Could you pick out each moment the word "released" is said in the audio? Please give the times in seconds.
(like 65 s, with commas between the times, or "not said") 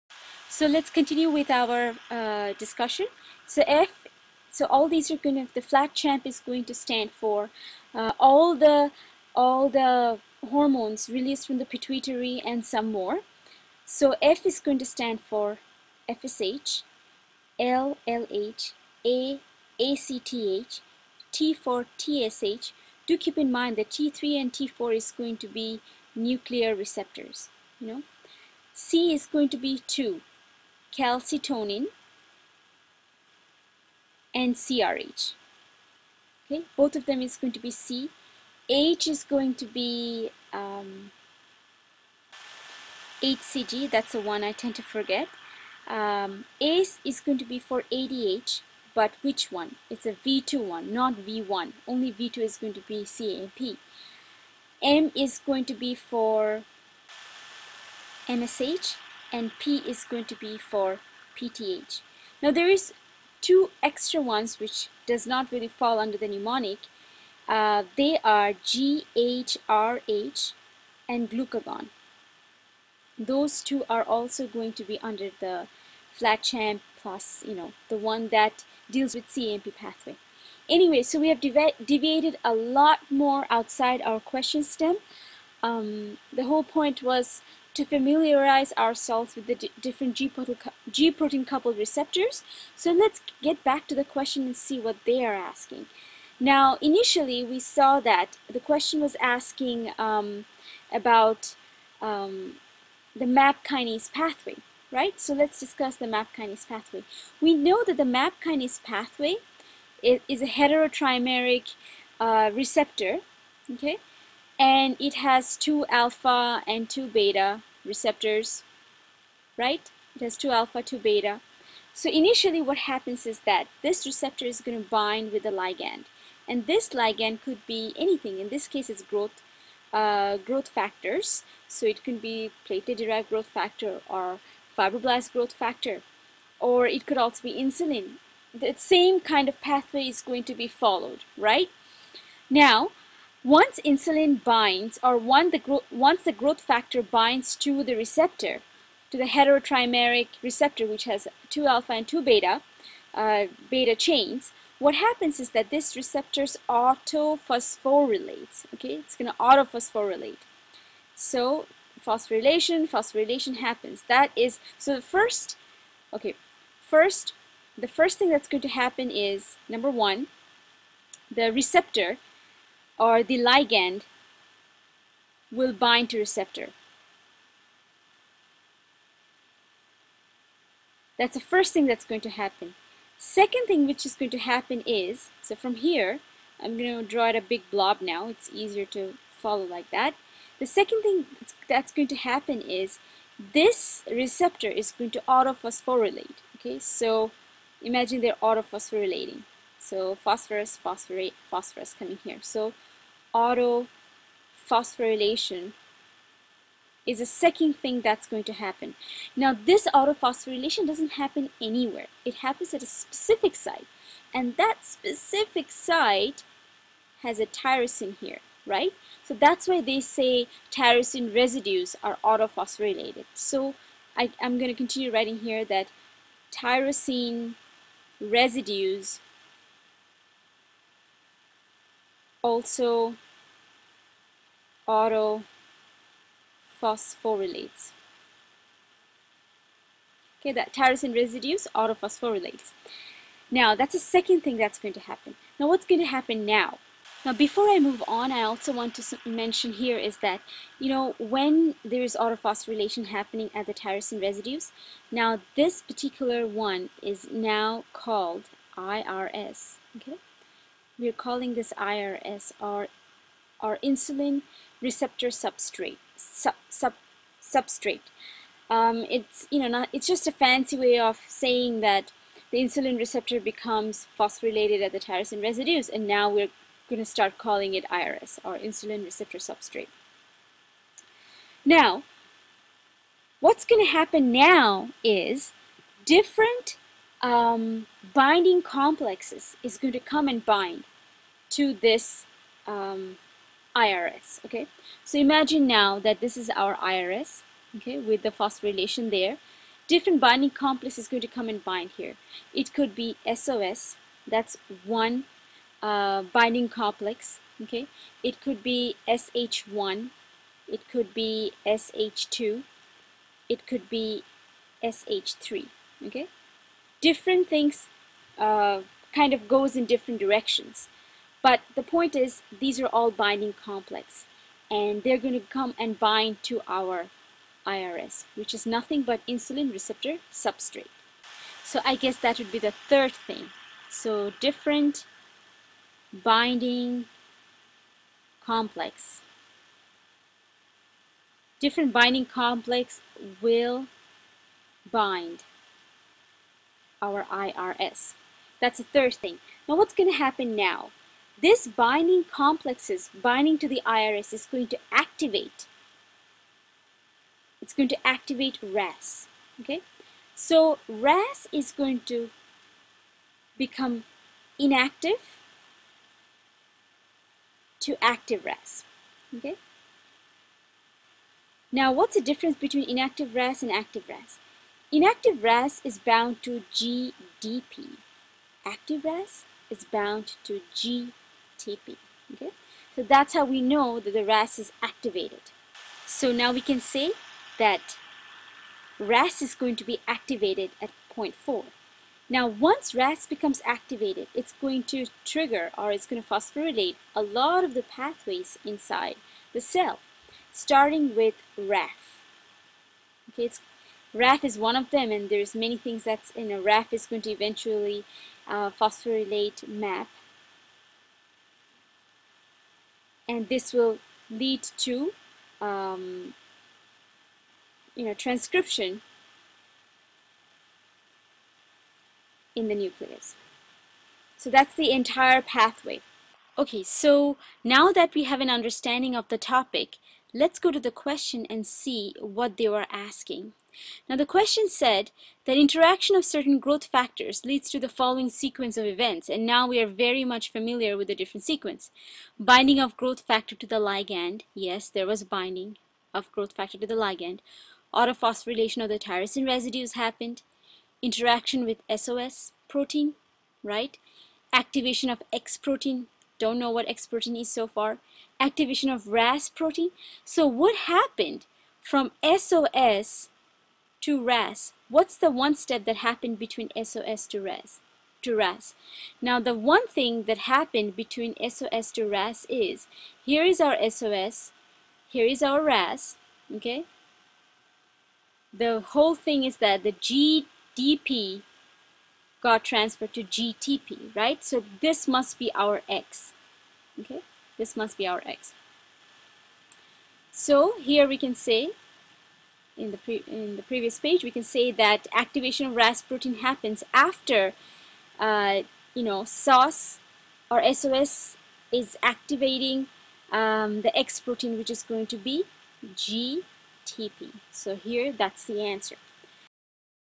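11 s.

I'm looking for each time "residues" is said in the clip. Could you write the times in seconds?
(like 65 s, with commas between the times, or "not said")
221 s, 228 s, 241 s, 254 s, 275 s, 449 s.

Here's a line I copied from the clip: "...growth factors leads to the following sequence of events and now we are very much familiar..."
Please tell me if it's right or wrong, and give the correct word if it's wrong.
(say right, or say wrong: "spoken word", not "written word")
right.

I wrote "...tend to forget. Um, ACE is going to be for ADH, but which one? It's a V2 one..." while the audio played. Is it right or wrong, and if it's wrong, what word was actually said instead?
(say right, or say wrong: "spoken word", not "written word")
right.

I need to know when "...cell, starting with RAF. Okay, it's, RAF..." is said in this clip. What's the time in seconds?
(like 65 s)
399 s.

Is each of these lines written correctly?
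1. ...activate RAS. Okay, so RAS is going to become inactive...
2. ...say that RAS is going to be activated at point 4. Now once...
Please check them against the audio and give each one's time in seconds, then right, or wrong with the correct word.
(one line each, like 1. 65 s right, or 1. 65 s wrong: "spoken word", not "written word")
1. 358 s right
2. 386 s right.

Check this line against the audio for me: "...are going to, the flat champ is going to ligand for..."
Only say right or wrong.
wrong.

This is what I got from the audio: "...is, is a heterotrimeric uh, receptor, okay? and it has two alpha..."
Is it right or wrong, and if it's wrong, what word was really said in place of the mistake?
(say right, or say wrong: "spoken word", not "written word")
right.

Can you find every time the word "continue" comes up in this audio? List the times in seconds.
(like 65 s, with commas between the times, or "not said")
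0 s, 224 s.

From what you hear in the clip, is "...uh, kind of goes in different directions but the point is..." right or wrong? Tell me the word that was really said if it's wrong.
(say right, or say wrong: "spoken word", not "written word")
right.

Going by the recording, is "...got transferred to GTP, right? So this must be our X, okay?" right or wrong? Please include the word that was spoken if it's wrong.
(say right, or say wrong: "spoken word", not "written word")
right.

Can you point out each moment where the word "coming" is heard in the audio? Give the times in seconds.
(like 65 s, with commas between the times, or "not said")
201 s.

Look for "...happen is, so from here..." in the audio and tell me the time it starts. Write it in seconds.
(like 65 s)
184 s.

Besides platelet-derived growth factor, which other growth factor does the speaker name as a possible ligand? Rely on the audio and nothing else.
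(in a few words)
fibroblast growth factor.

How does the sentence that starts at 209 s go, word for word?
Now this autophosphorylation doesn't happen anywhere.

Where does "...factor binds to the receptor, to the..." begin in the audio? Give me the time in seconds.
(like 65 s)
146 s.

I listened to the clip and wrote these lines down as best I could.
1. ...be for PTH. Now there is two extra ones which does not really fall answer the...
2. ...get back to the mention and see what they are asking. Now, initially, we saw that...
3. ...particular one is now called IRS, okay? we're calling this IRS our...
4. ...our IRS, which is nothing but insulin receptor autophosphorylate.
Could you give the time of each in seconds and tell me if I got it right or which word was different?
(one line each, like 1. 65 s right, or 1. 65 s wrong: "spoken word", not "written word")
1. 60 s wrong: "under", not "answer"
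2. 93 s wrong: "question", not "mention"
3. 255 s right
4. 326 s wrong: "substrate", not "autophosphorylate".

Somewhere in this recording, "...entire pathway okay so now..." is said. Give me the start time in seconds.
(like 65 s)
424 s.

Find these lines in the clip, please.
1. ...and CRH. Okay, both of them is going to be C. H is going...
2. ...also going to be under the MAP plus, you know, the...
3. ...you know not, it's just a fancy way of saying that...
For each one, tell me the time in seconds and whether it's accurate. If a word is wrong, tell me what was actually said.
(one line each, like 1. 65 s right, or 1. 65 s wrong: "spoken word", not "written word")
1. 34 s right
2. 74 s wrong: "FlatChamp", not "MAP"
3. 269 s right.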